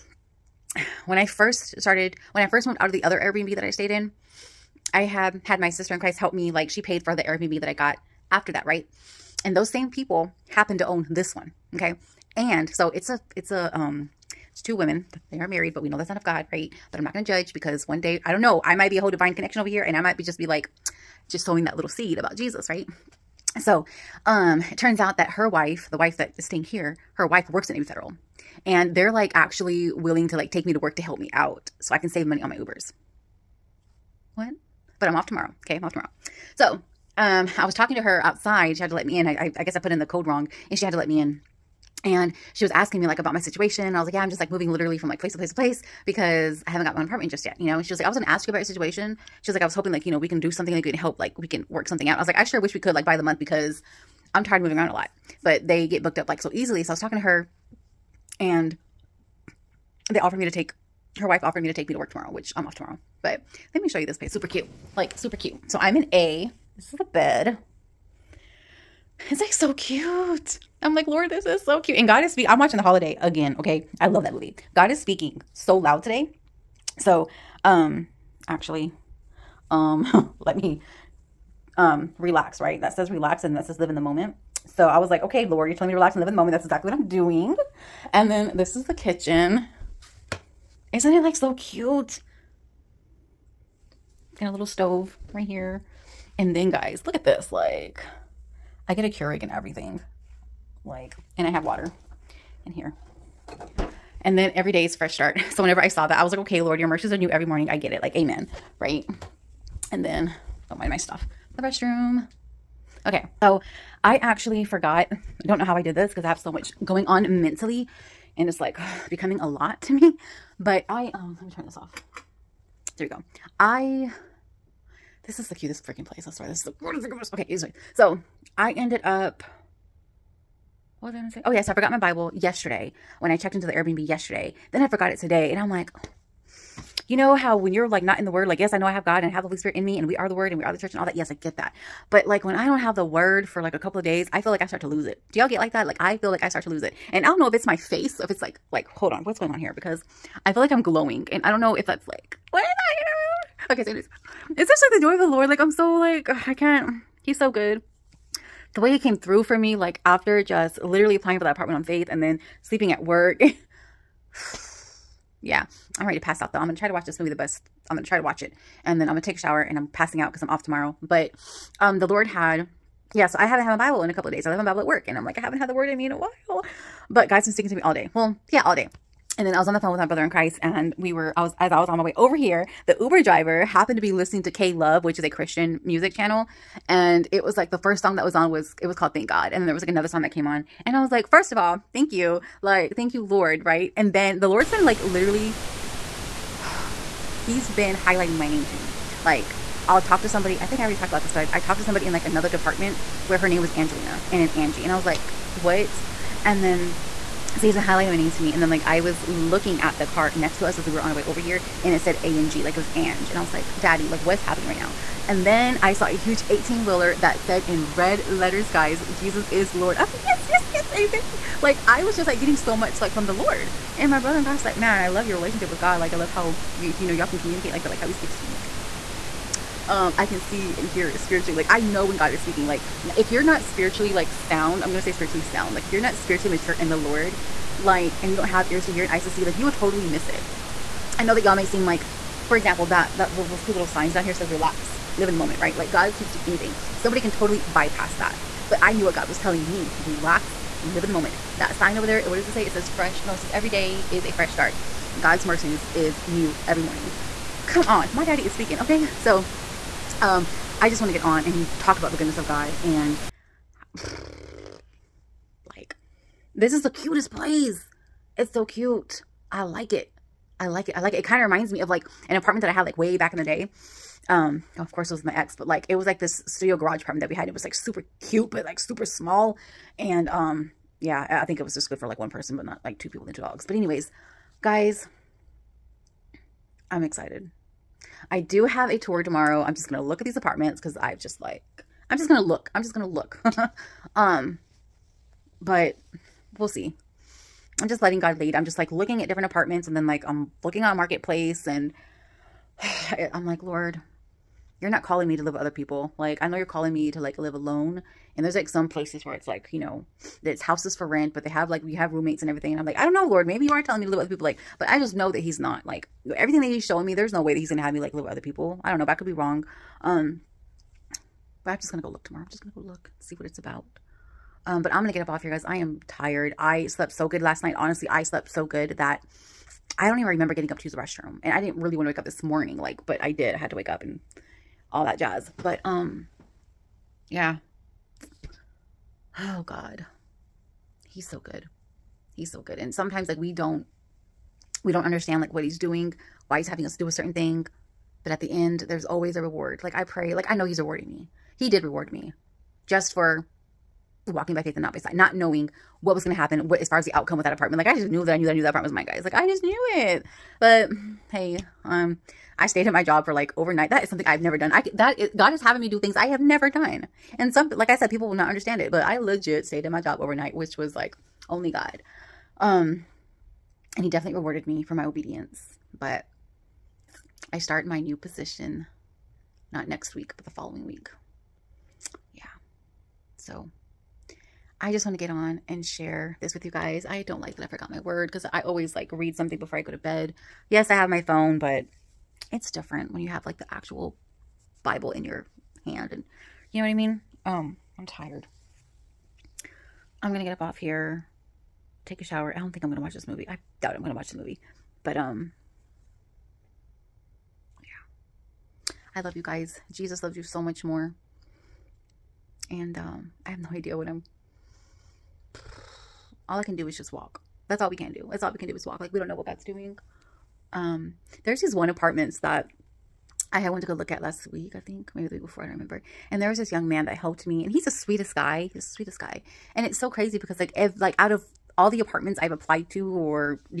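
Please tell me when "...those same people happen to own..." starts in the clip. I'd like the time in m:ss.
0:09.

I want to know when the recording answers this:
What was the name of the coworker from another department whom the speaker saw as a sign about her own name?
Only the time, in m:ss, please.
3:23.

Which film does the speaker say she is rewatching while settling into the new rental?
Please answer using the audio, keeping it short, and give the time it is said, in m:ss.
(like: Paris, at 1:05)
The Holiday, at 1:12.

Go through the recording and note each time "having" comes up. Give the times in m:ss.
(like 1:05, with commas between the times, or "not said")
5:46, 6:05.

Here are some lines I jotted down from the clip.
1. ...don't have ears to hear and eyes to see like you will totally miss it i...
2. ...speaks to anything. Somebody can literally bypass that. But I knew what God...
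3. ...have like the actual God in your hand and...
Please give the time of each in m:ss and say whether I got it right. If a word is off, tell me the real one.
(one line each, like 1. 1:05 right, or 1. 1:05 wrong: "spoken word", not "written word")
1. 3:58 right
2. 4:06 wrong: "totally", not "literally"
3. 6:33 wrong: "Bible", not "God".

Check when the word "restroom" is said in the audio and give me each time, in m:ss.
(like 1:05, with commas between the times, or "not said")
1:51, 5:30.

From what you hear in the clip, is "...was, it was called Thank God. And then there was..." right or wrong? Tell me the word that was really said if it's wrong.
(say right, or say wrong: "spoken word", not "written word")
right.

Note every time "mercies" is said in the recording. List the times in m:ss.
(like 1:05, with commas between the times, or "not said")
1:46, 4:15.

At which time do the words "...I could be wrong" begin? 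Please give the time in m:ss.
5:19.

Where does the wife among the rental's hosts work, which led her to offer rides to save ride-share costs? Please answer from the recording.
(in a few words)
Navy Federal.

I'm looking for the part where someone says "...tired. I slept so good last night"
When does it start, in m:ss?
5:26.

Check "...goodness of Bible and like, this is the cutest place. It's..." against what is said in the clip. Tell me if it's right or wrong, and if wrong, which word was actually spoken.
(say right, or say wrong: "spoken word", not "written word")
wrong: "God", not "Bible".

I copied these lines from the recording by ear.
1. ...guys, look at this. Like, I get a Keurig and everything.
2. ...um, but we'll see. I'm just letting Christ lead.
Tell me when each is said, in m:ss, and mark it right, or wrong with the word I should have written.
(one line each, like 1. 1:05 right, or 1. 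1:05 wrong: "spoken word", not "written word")
1. 1:36 right
2. 4:54 wrong: "God", not "Christ".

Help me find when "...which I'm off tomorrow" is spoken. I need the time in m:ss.
1:02.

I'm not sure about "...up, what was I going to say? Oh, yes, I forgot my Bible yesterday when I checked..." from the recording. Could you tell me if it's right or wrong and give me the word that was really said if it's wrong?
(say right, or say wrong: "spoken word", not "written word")
right.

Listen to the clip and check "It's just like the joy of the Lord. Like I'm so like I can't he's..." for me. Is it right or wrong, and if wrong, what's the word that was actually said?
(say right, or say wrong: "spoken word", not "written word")
right.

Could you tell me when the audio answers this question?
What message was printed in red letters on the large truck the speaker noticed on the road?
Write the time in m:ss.
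3:39.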